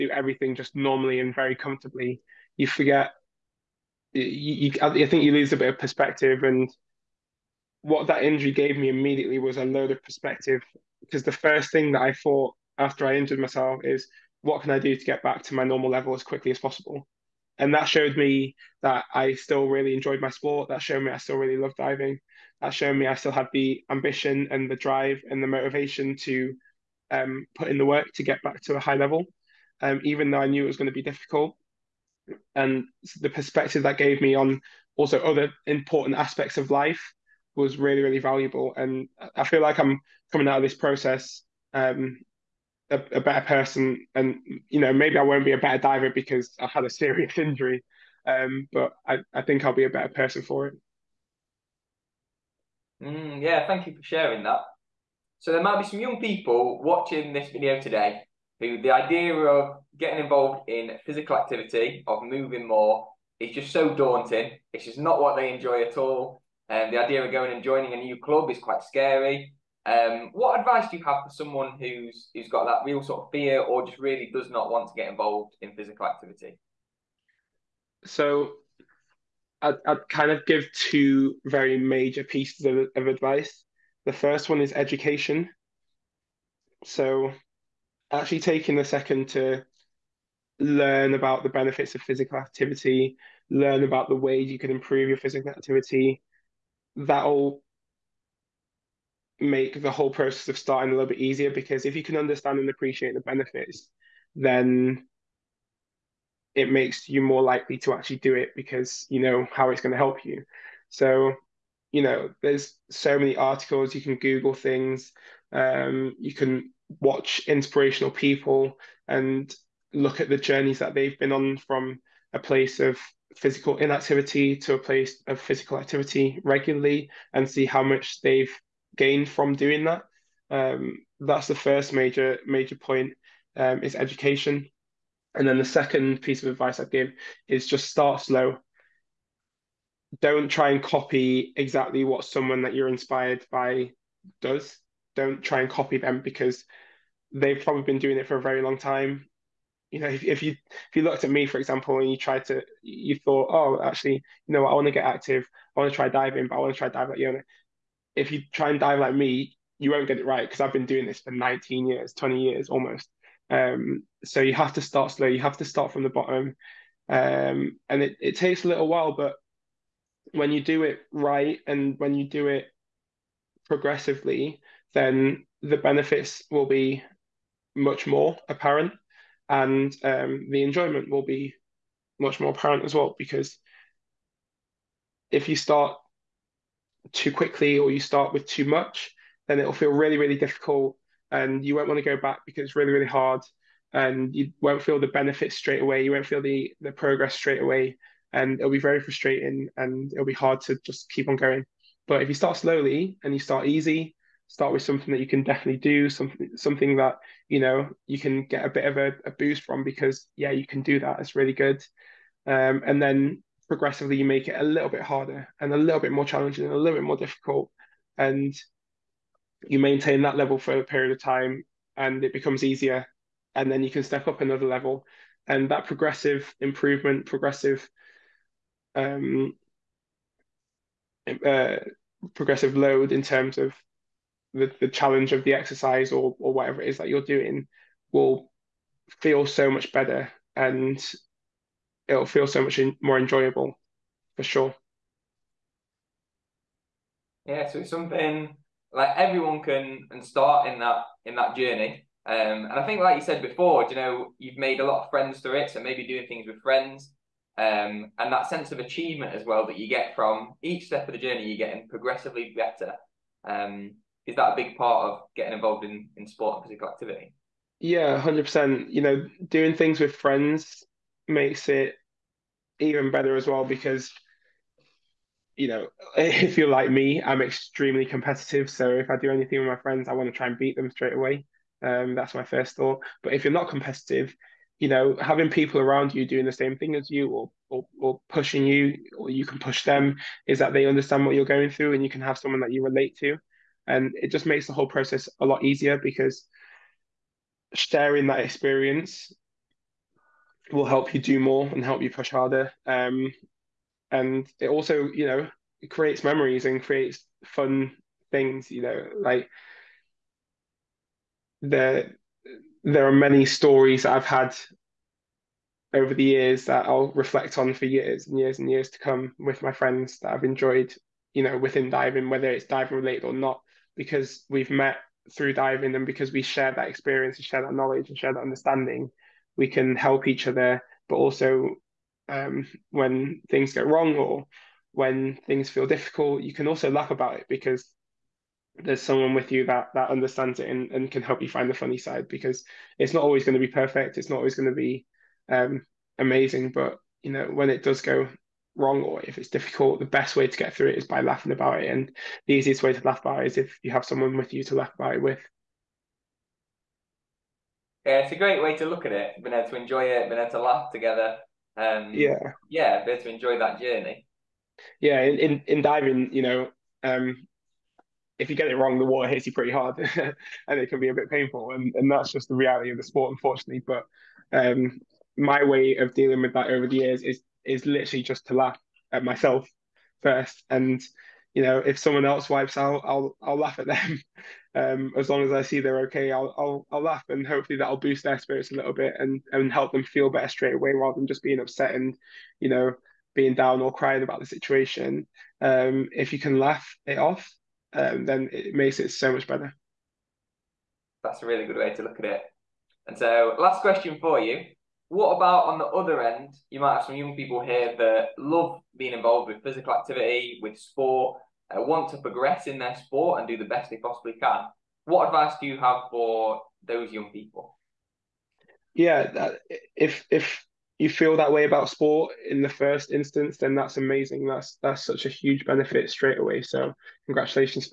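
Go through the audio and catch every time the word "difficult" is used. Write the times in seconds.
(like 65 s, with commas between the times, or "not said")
31 s, 190 s, 217 s, 335 s, 349 s.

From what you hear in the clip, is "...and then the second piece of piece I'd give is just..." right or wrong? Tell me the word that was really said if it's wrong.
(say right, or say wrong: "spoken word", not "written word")
wrong: "advice", not "piece".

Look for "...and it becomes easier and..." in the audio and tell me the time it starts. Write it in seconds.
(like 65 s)
221 s.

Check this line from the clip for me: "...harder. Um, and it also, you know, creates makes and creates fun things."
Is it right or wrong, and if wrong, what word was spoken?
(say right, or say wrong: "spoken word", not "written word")
wrong: "memories", not "makes".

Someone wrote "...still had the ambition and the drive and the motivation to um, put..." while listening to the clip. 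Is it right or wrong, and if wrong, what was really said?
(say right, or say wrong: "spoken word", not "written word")
right.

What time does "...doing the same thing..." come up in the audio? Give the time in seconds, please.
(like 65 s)
286 s.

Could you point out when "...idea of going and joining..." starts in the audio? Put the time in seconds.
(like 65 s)
67 s.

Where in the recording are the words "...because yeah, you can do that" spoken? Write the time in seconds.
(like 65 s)
209 s.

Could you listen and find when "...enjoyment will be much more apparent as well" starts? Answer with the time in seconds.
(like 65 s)
180 s.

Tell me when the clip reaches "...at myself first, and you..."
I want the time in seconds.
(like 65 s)
379 s.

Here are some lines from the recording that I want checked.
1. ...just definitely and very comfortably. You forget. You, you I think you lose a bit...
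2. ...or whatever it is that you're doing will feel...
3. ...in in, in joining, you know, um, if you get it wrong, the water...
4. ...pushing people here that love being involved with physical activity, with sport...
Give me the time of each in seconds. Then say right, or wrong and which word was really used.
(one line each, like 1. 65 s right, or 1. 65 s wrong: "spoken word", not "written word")
1. 0 s wrong: "normally", not "definitely"
2. 236 s right
3. 365 s wrong: "diving", not "joining"
4. 407 s wrong: "young", not "pushing".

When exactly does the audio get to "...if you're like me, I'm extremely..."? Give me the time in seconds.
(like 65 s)
276 s.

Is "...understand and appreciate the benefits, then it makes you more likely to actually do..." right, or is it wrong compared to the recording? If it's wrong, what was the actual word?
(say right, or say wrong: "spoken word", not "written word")
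right.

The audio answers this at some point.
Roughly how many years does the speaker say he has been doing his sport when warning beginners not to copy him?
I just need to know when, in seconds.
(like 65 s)
161 s.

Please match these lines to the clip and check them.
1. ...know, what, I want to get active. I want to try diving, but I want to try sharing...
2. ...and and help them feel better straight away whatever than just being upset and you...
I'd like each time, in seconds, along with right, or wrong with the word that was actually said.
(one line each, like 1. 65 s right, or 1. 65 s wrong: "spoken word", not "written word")
1. 154 s wrong: "diving", not "sharing"
2. 389 s wrong: "rather", not "whatever".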